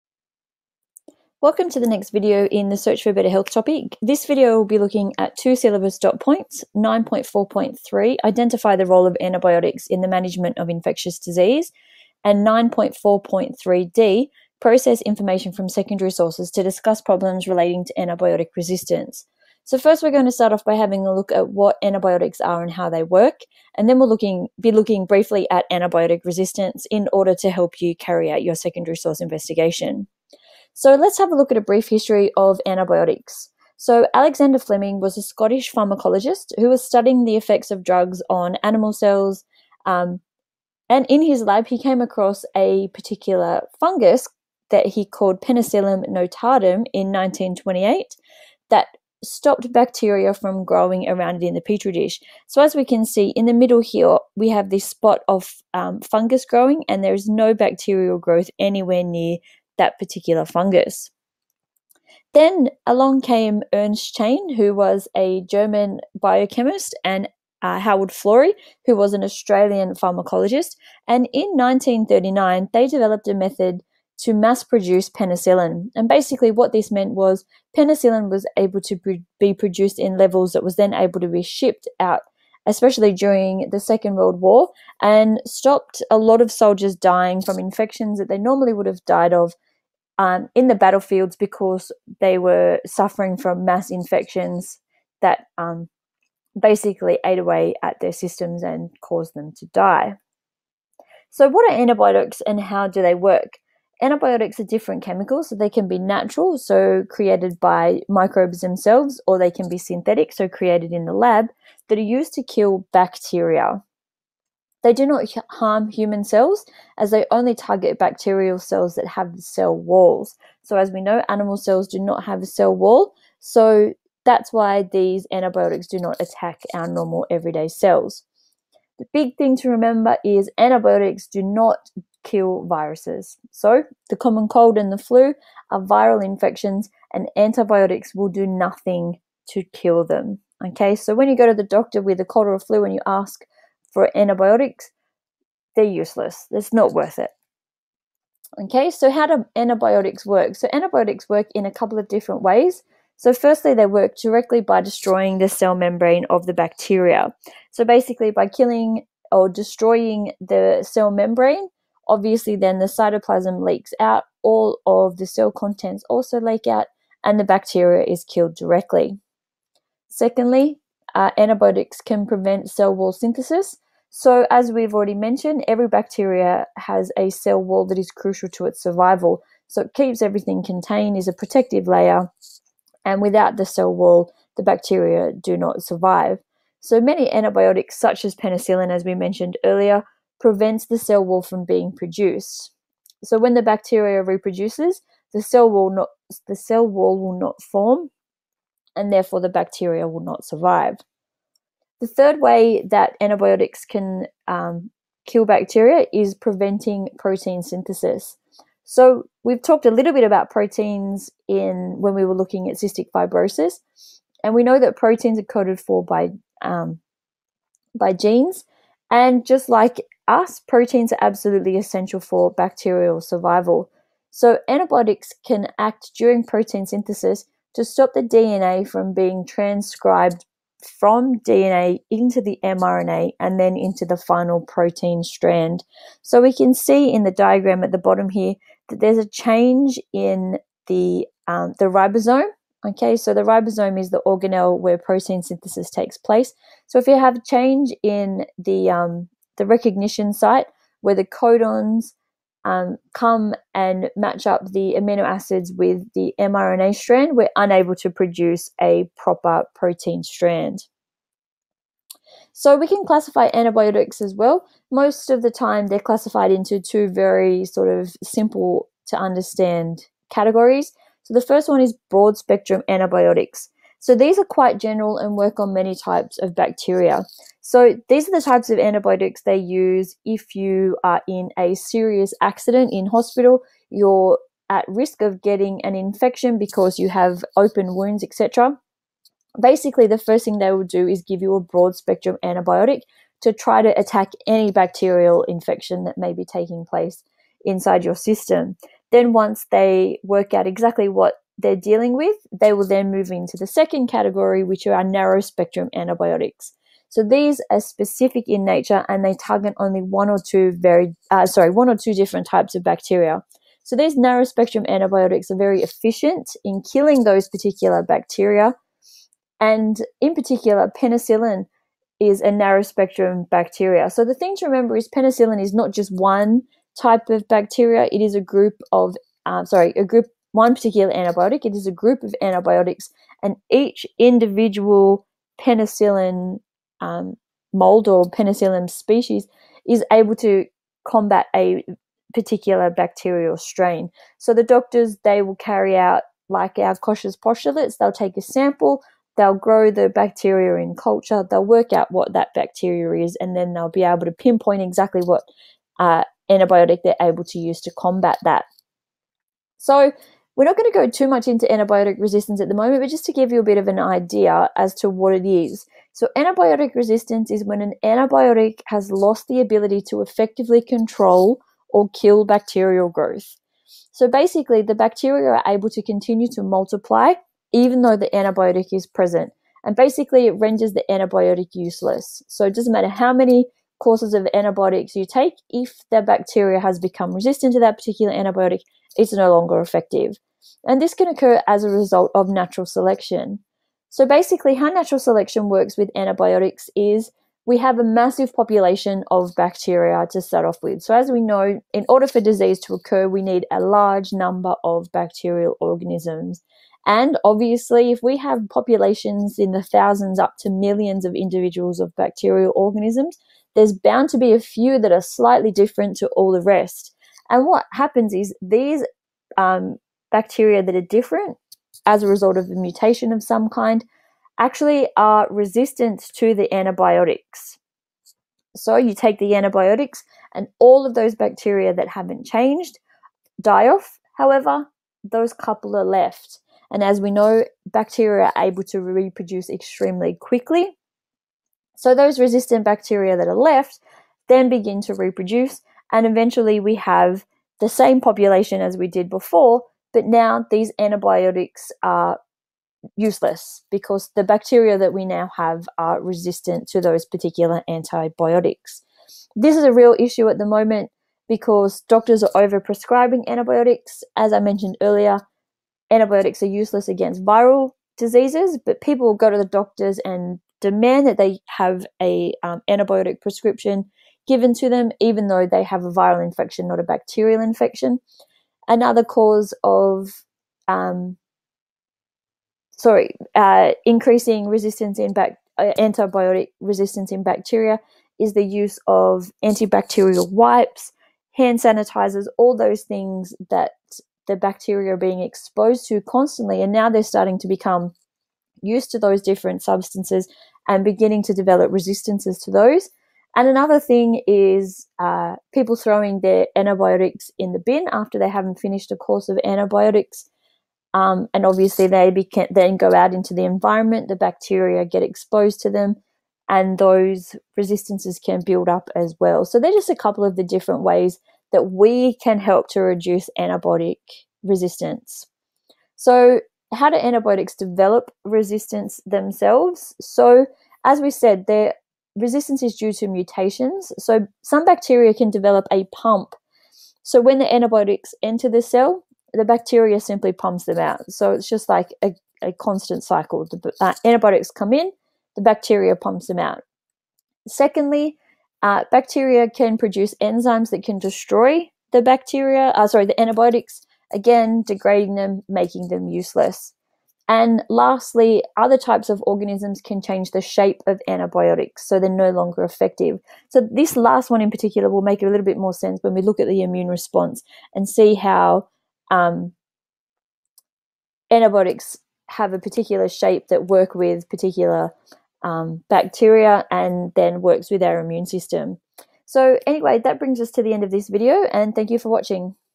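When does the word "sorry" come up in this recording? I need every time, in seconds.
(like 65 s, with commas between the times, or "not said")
311 s, 329 s, 482 s, 553 s.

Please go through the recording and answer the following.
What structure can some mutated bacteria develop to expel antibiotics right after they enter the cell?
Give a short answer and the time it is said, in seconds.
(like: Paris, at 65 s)
a pump, at 535 s.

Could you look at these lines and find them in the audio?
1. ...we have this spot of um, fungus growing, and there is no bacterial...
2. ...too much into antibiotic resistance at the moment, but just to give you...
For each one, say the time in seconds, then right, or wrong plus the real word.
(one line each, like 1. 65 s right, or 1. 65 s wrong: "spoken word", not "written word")
1. 54 s right
2. 361 s right.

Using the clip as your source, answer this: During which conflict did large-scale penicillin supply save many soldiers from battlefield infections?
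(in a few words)
Second World War.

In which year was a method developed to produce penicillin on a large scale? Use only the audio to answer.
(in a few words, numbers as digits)
1939.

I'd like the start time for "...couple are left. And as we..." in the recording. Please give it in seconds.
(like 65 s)
435 s.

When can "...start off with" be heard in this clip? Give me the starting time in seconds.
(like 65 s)
400 s.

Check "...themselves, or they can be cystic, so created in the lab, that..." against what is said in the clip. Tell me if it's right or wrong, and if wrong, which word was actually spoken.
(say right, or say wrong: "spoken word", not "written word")
wrong: "synthetic", not "cystic".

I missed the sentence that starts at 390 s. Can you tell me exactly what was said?
And this can occur as a result of natural selection.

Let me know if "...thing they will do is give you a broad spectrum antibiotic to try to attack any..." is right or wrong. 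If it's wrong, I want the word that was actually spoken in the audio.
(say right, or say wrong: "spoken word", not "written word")
right.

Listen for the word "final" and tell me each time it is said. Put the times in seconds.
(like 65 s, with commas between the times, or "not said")
234 s.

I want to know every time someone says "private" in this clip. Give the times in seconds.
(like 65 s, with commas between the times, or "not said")
not said.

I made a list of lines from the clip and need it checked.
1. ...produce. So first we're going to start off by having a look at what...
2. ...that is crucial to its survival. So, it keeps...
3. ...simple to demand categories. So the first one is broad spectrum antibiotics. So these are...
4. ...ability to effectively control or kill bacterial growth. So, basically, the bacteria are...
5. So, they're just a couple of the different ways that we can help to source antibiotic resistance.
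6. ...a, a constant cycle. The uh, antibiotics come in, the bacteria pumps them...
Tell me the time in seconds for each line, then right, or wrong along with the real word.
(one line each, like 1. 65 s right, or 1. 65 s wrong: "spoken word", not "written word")
1. 18 s wrong: "resistance", not "produce"
2. 177 s right
3. 268 s wrong: "understand", not "demand"
4. 369 s right
5. 519 s wrong: "reduce", not "source"
6. 542 s right.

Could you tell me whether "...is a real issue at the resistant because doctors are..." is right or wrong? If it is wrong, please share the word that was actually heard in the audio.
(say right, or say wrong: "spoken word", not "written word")
wrong: "moment", not "resistant".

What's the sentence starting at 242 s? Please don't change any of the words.
Okay, so the ribosome is the organelle where protein synthesis takes place.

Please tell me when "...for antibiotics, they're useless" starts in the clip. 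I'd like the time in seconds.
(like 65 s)
143 s.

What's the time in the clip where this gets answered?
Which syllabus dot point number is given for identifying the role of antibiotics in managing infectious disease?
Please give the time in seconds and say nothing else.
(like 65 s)
6 s.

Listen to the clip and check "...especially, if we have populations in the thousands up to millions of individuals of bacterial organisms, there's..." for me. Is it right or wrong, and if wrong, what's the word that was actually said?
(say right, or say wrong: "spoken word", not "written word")
wrong: "obviously", not "especially".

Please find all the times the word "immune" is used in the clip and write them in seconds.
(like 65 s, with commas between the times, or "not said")
566 s, 578 s.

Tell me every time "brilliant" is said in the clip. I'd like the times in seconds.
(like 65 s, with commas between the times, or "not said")
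not said.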